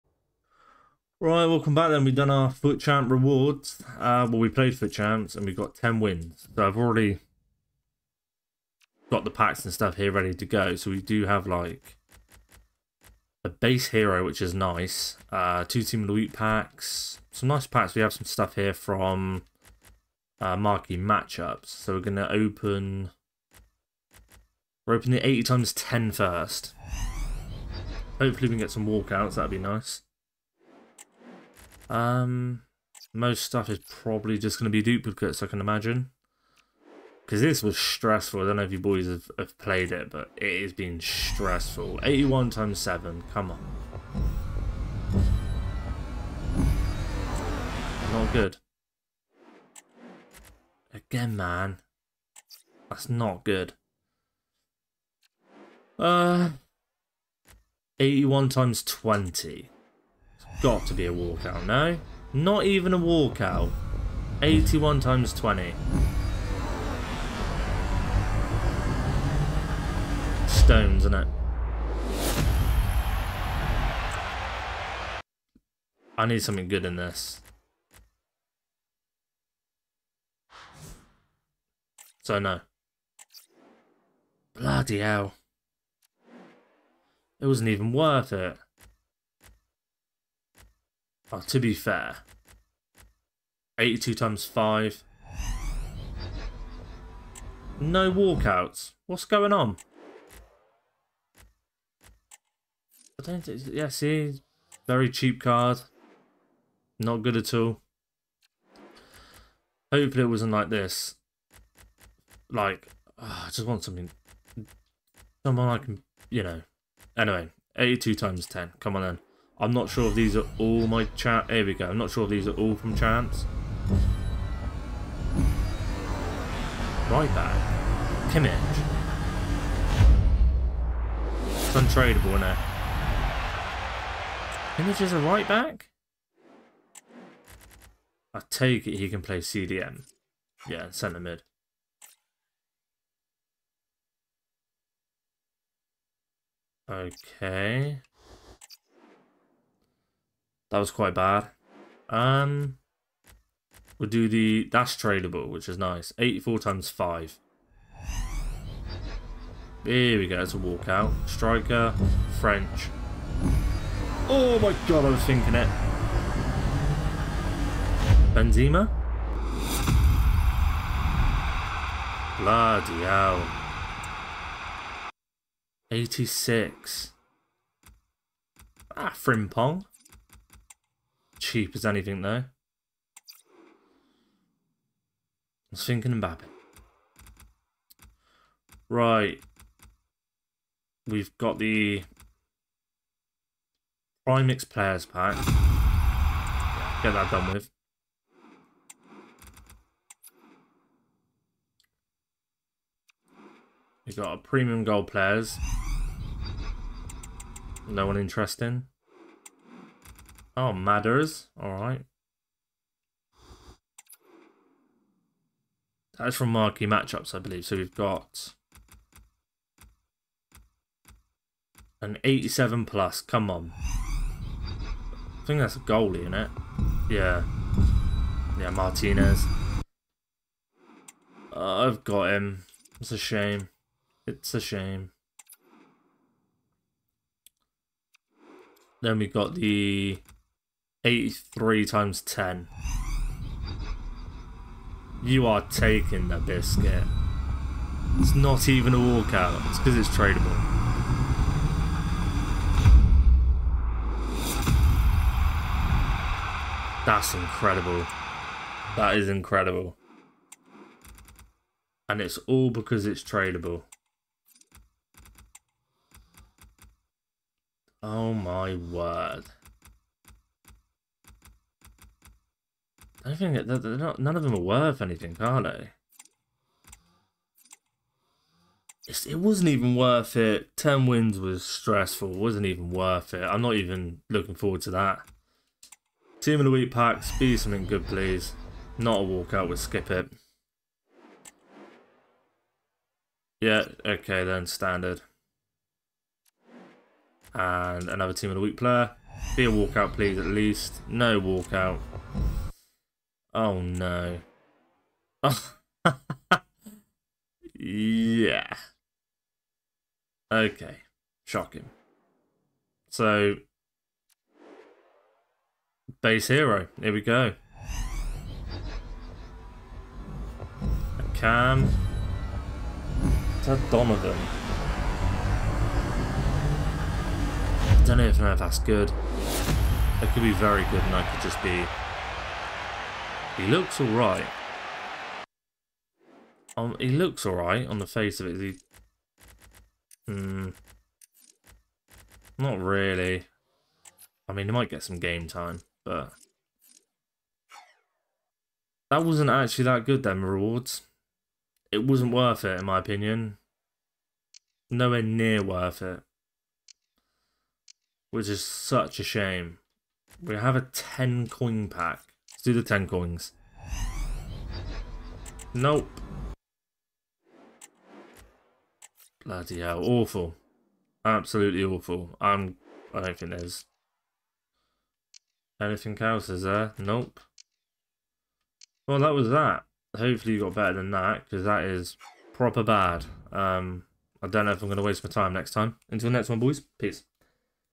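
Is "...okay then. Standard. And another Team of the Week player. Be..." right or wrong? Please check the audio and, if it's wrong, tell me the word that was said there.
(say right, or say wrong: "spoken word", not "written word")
right.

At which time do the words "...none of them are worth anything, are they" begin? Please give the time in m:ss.
4:34.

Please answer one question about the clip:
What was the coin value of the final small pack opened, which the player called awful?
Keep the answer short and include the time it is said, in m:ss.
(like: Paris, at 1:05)
10 coins, at 6:02.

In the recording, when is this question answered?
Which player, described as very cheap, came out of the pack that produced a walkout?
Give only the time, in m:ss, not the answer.
2:59.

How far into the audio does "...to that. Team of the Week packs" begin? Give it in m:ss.
4:44.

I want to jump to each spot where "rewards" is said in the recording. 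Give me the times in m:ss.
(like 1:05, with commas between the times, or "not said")
0:03, 5:50.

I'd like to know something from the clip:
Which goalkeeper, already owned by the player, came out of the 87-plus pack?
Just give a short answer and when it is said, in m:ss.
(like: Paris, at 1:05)
Martinez, at 3:48.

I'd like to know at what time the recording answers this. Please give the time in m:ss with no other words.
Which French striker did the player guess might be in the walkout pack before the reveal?
2:48.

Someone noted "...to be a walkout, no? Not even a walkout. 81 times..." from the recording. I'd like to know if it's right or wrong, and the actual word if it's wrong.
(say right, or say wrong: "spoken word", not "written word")
right.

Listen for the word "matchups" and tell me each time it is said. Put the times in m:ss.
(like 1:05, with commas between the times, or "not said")
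0:20, 3:36.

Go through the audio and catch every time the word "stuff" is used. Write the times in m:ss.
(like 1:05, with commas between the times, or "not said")
0:09, 0:18, 0:33.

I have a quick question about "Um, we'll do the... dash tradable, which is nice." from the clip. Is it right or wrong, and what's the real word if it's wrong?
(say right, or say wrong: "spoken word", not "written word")
right.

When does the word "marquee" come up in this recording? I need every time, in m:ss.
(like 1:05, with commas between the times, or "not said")
0:20, 3:36.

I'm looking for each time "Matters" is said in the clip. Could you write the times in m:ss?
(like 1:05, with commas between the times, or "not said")
3:30.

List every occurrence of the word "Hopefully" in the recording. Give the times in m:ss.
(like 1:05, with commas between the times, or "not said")
0:28, 1:49, 6:20.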